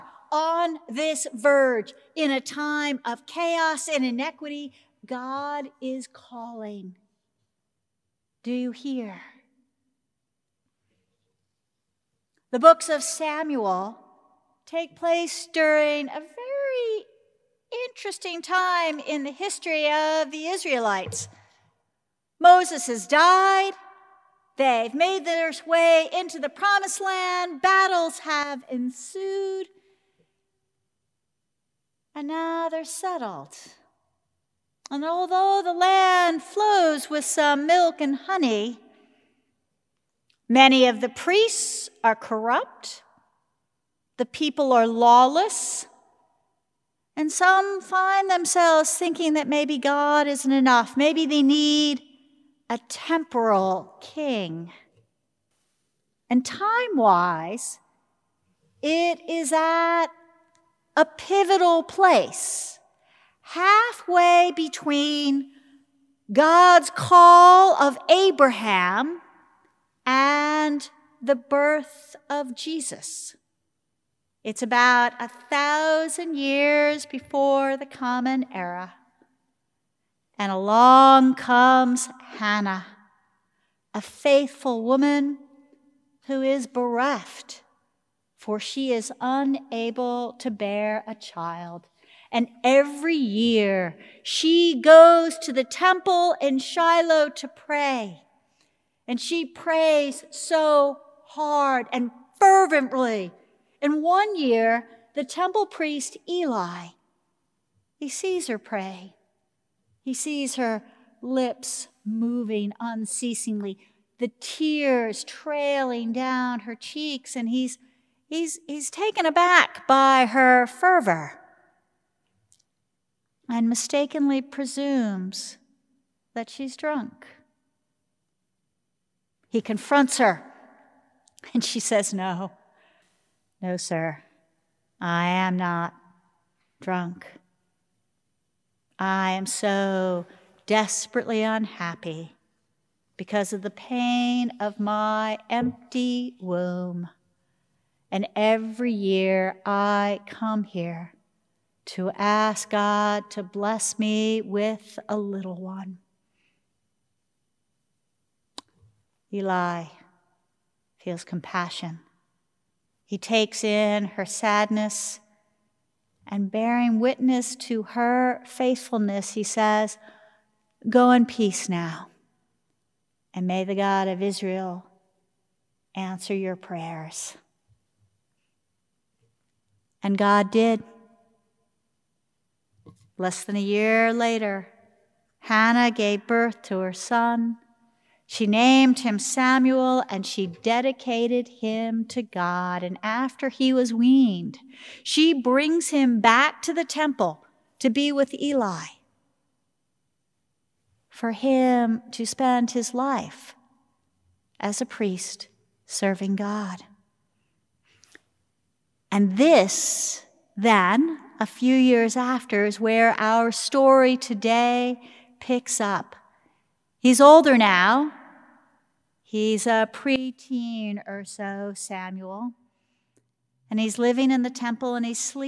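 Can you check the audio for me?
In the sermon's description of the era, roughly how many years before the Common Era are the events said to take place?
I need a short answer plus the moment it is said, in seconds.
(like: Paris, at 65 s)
1000, at 75 s.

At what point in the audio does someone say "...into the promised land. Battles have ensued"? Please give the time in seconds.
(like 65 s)
26 s.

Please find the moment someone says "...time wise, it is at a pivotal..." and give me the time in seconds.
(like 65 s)
56 s.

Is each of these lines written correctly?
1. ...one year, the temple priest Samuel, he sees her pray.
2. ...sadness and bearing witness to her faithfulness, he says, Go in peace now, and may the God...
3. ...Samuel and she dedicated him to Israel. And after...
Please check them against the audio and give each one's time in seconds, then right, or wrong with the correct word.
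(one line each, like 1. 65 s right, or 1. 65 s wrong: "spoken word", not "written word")
1. 104 s wrong: "Eli", not "Samuel"
2. 164 s right
3. 189 s wrong: "God", not "Israel".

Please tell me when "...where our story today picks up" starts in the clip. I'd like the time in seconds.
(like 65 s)
212 s.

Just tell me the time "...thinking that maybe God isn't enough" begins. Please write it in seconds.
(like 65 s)
48 s.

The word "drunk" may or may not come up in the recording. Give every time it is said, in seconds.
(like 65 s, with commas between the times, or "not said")
126 s, 136 s.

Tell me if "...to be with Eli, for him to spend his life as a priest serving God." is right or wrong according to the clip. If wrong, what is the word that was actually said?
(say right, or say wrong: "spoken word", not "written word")
right.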